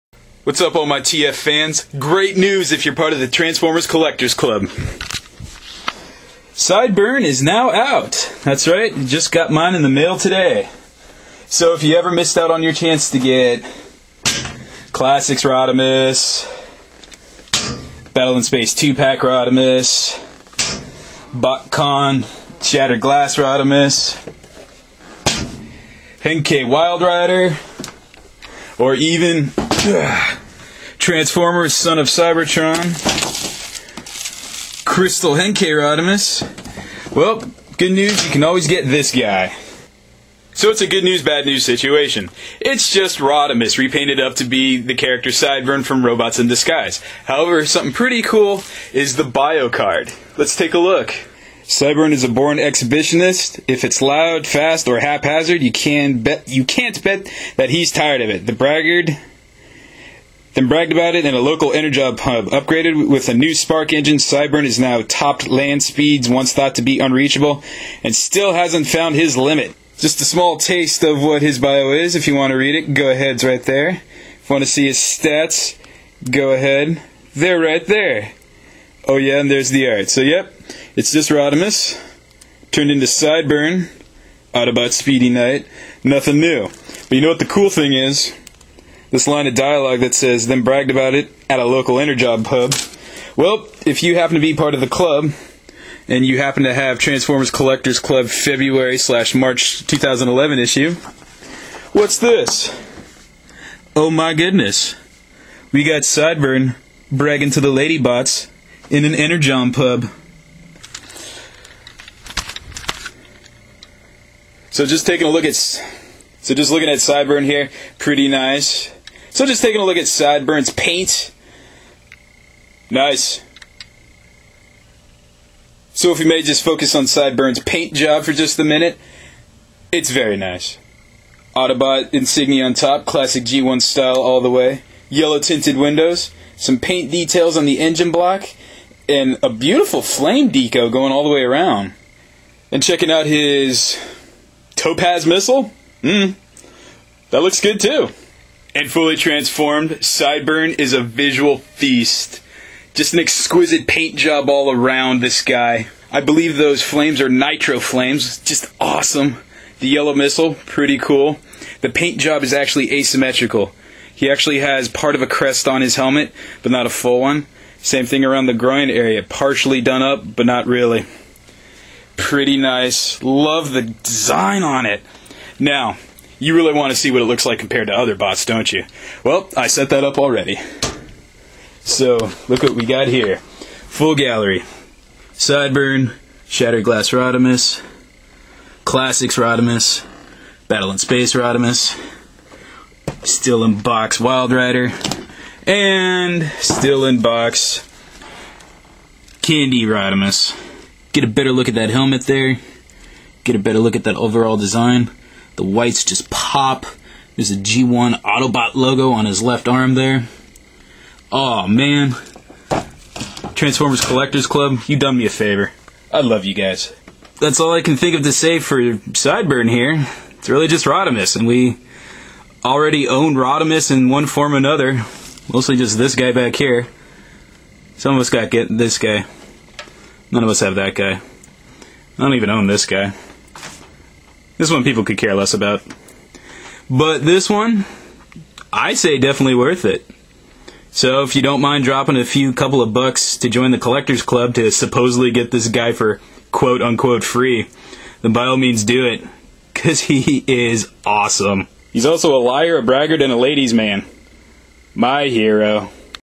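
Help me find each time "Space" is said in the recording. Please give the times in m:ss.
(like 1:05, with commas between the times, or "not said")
0:18, 3:10.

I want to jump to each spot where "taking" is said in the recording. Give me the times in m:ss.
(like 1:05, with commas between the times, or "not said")
1:55, 1:59.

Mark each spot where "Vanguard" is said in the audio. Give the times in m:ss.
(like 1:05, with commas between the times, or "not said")
not said.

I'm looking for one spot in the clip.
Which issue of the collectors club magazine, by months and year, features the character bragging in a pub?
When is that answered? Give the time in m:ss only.
1:38.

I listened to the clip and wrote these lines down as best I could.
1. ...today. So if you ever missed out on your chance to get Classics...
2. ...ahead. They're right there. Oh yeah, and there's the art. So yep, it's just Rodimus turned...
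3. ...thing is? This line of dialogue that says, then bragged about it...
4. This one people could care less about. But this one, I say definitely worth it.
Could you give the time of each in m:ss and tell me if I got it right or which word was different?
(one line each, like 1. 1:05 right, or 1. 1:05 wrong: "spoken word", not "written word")
1. 0:10 right
2. 1:16 right
3. 1:27 right
4. 3:54 right.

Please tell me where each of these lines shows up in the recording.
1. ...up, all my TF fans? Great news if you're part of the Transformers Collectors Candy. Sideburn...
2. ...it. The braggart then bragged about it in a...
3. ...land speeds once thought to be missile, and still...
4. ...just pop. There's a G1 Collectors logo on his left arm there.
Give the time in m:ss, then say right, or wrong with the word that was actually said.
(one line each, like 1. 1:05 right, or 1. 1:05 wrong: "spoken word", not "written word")
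1. 0:00 wrong: "Club", not "Candy"
2. 0:58 right
3. 1:05 wrong: "unreachable", not "missile"
4. 3:26 wrong: "Autobot", not "Collectors".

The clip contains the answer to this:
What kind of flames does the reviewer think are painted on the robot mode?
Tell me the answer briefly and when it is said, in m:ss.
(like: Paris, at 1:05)
Nitro flames, at 2:37.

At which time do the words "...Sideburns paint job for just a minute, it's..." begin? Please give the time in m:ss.
2:07.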